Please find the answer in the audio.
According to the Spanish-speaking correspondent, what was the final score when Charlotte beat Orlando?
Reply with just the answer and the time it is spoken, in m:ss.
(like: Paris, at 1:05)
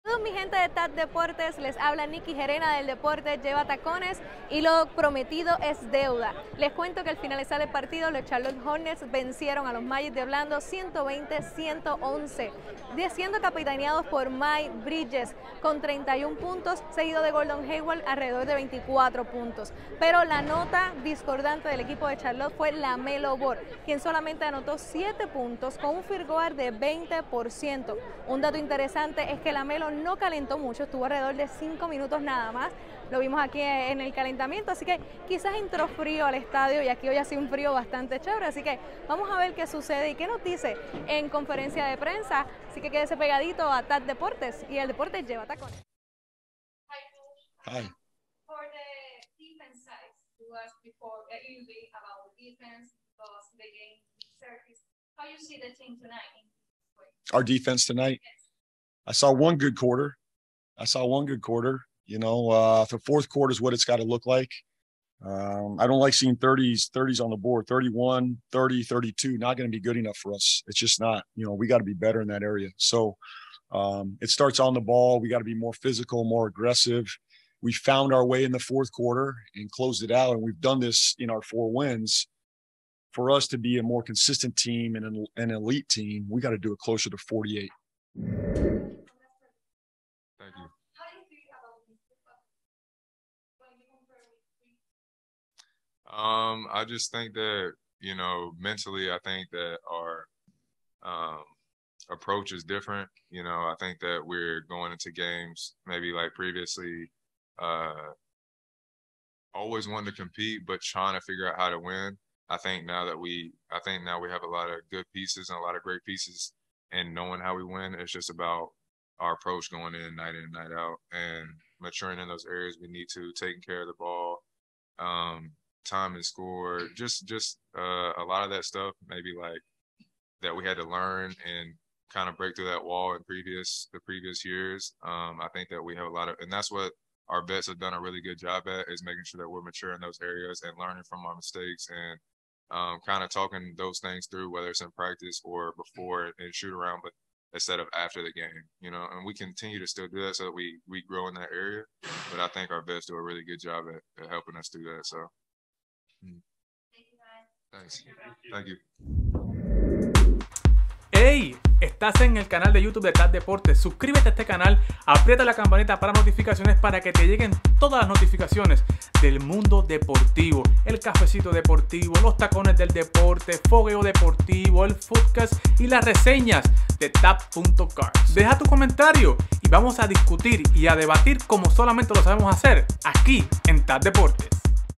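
120-111, at 0:10.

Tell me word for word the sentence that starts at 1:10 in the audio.
It's just not, you know, we got to be better in that area.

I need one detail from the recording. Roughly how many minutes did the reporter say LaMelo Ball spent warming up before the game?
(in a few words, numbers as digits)
5 minutes.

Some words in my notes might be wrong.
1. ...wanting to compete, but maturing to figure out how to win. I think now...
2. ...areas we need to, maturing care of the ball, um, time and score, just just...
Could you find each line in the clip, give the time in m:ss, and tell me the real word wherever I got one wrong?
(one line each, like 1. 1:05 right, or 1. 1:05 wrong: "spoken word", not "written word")
1. 1:49 wrong: "trying", not "maturing"
2. 2:02 wrong: "taking", not "maturing".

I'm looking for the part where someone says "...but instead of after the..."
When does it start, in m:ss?
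2:27.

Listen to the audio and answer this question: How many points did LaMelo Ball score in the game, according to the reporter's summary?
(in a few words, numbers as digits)
7.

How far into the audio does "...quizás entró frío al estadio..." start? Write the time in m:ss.
0:35.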